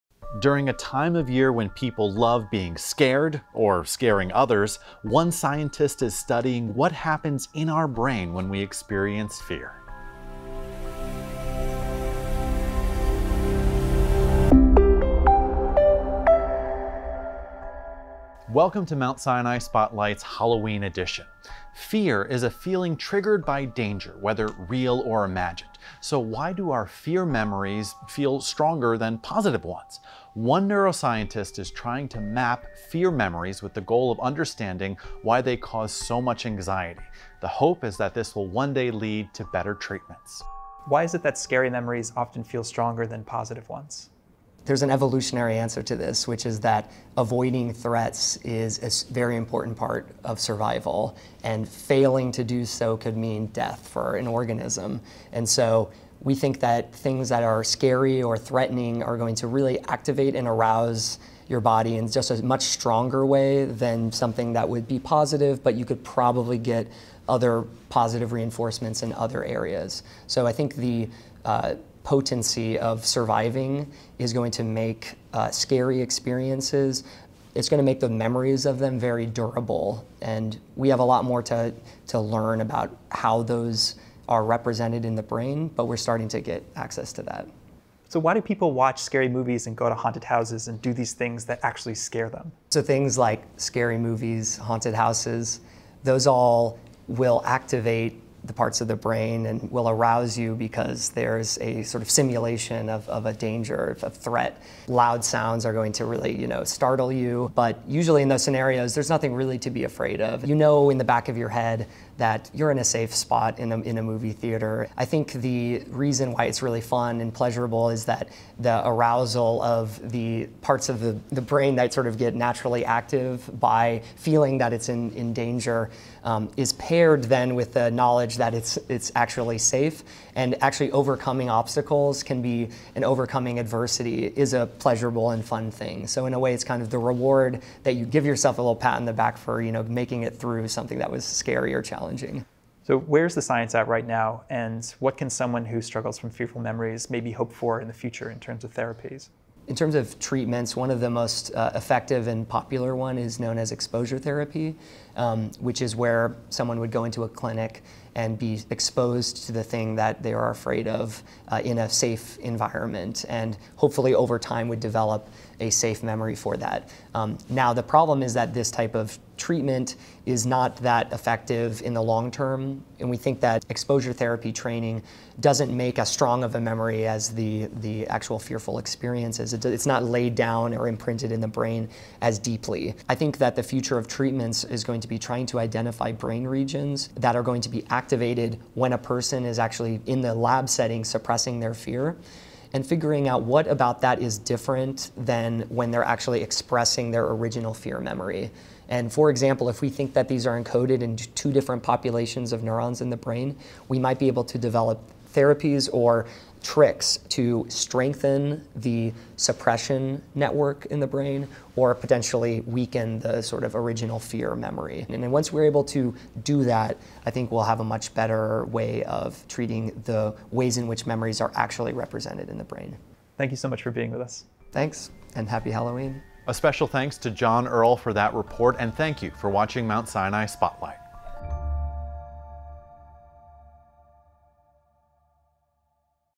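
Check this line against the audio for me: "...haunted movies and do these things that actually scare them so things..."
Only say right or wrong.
wrong.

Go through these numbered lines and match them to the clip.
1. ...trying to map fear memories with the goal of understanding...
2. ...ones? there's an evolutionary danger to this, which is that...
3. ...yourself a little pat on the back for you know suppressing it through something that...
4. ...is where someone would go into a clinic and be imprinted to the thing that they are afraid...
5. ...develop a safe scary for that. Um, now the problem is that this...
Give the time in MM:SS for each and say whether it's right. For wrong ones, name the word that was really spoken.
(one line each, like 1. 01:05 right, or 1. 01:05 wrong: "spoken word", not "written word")
1. 00:31 right
2. 00:43 wrong: "answer", not "danger"
3. 02:18 wrong: "making", not "suppressing"
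4. 02:35 wrong: "exposed", not "imprinted"
5. 02:44 wrong: "memory", not "scary".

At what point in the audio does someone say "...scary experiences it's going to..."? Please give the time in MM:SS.
01:15.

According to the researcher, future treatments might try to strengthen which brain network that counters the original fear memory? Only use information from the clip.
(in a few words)
Suppression network.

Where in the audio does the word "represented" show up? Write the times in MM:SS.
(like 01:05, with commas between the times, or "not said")
01:24, 03:41.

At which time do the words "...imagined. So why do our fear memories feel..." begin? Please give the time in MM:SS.
00:25.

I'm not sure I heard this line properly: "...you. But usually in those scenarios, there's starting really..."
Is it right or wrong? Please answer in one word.
wrong.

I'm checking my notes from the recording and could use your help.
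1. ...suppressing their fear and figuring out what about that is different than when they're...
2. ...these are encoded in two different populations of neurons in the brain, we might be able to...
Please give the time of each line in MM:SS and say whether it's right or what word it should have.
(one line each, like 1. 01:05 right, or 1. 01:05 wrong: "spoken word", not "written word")
1. 03:11 right
2. 03:20 right.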